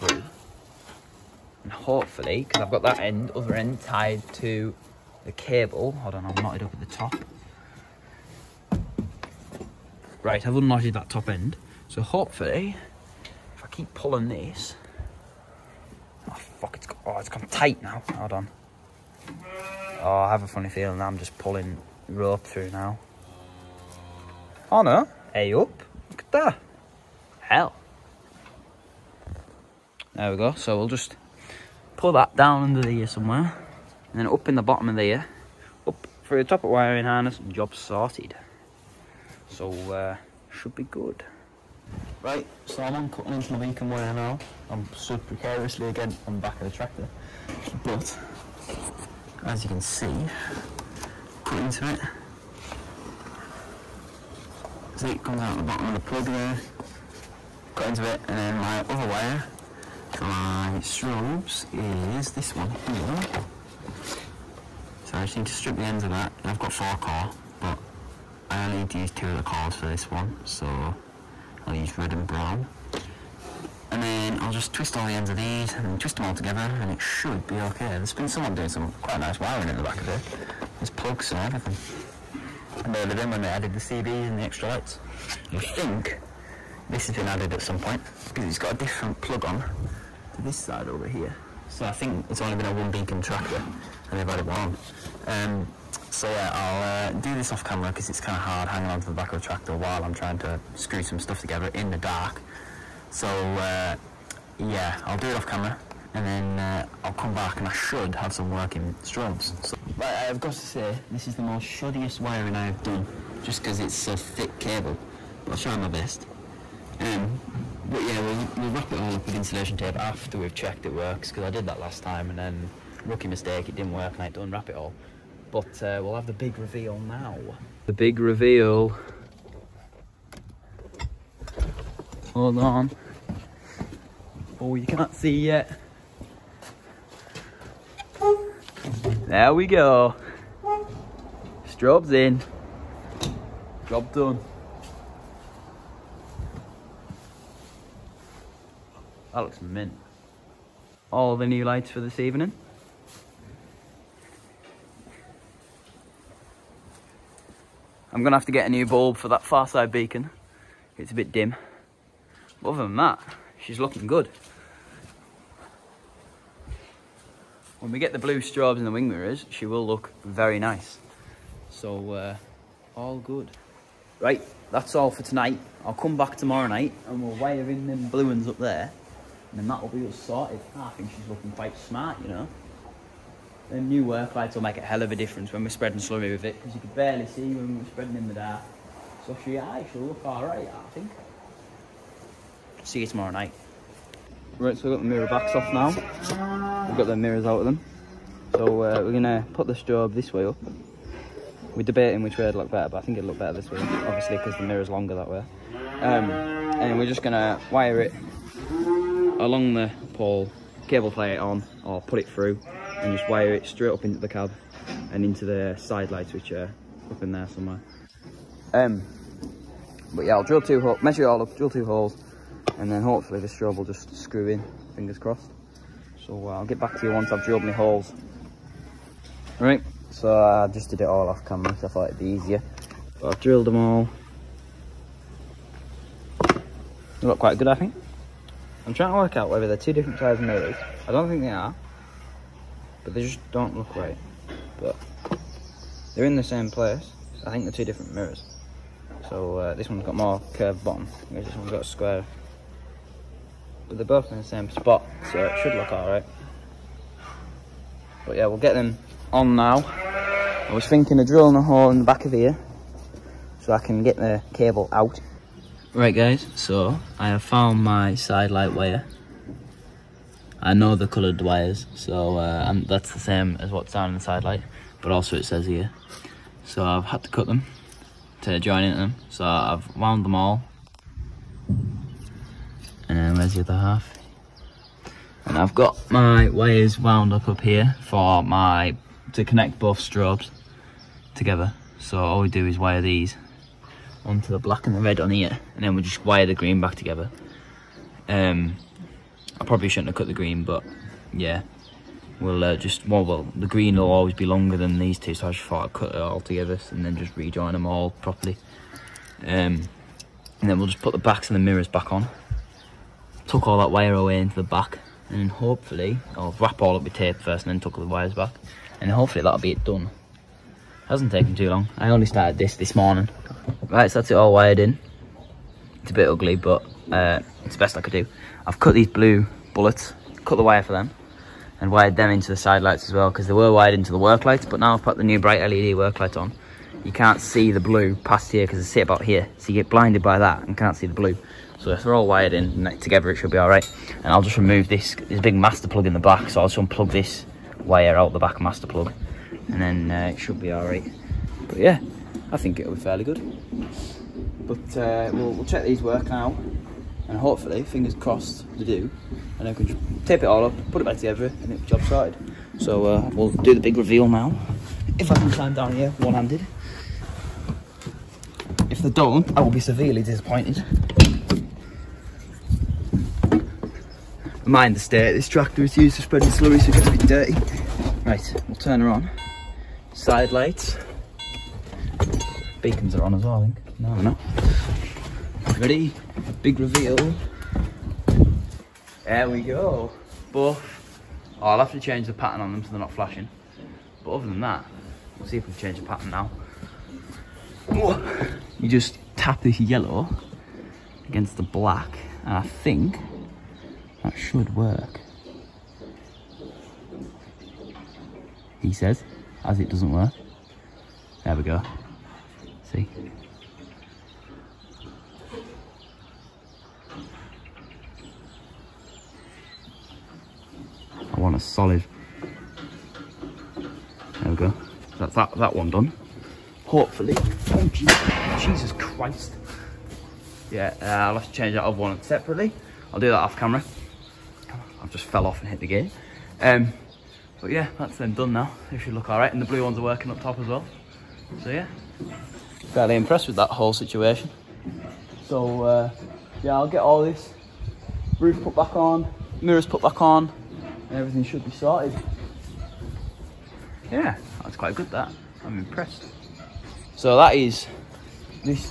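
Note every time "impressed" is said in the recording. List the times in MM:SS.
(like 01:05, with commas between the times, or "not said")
07:23, 07:35.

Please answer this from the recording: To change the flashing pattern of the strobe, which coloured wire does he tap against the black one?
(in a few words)
Yellow.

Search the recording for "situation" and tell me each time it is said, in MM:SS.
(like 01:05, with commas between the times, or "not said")
07:23.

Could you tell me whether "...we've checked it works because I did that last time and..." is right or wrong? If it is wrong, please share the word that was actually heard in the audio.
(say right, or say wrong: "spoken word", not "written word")
right.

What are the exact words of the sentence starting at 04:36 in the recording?
So I've had to cut them to join into them, so I've wound them all.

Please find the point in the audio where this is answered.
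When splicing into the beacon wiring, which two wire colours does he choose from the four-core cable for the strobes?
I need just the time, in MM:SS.
01:11.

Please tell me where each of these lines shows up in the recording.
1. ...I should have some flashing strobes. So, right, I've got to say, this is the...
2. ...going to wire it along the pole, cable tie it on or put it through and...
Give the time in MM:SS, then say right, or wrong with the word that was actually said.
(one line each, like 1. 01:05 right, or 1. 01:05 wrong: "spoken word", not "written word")
1. 01:47 wrong: "working", not "flashing"
2. 03:27 right.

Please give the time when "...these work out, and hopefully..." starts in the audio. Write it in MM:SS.
05:55.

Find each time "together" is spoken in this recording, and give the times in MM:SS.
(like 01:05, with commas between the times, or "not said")
01:16, 01:41, 04:51, 04:56, 05:06, 05:42, 06:01.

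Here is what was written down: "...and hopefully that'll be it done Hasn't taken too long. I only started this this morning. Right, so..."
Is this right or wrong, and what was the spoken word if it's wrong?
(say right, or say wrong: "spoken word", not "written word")
right.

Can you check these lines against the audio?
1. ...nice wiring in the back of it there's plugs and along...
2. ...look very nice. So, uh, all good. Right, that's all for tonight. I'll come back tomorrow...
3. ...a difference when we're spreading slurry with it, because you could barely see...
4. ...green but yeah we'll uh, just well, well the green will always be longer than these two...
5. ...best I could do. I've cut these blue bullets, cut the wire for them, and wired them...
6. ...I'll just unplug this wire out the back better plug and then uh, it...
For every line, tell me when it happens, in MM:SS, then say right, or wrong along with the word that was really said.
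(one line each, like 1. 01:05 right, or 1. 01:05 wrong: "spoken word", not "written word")
1. 01:19 wrong: "everything", not "along"
2. 02:49 right
3. 03:05 right
4. 05:00 right
5. 05:27 right
6. 05:46 wrong: "master", not "better".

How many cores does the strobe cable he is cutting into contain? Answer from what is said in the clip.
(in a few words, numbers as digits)
4.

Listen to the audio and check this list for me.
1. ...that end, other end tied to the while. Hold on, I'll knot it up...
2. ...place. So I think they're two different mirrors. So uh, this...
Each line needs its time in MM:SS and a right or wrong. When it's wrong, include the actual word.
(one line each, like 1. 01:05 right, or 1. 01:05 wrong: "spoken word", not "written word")
1. 00:02 wrong: "cable", not "while"
2. 04:06 right.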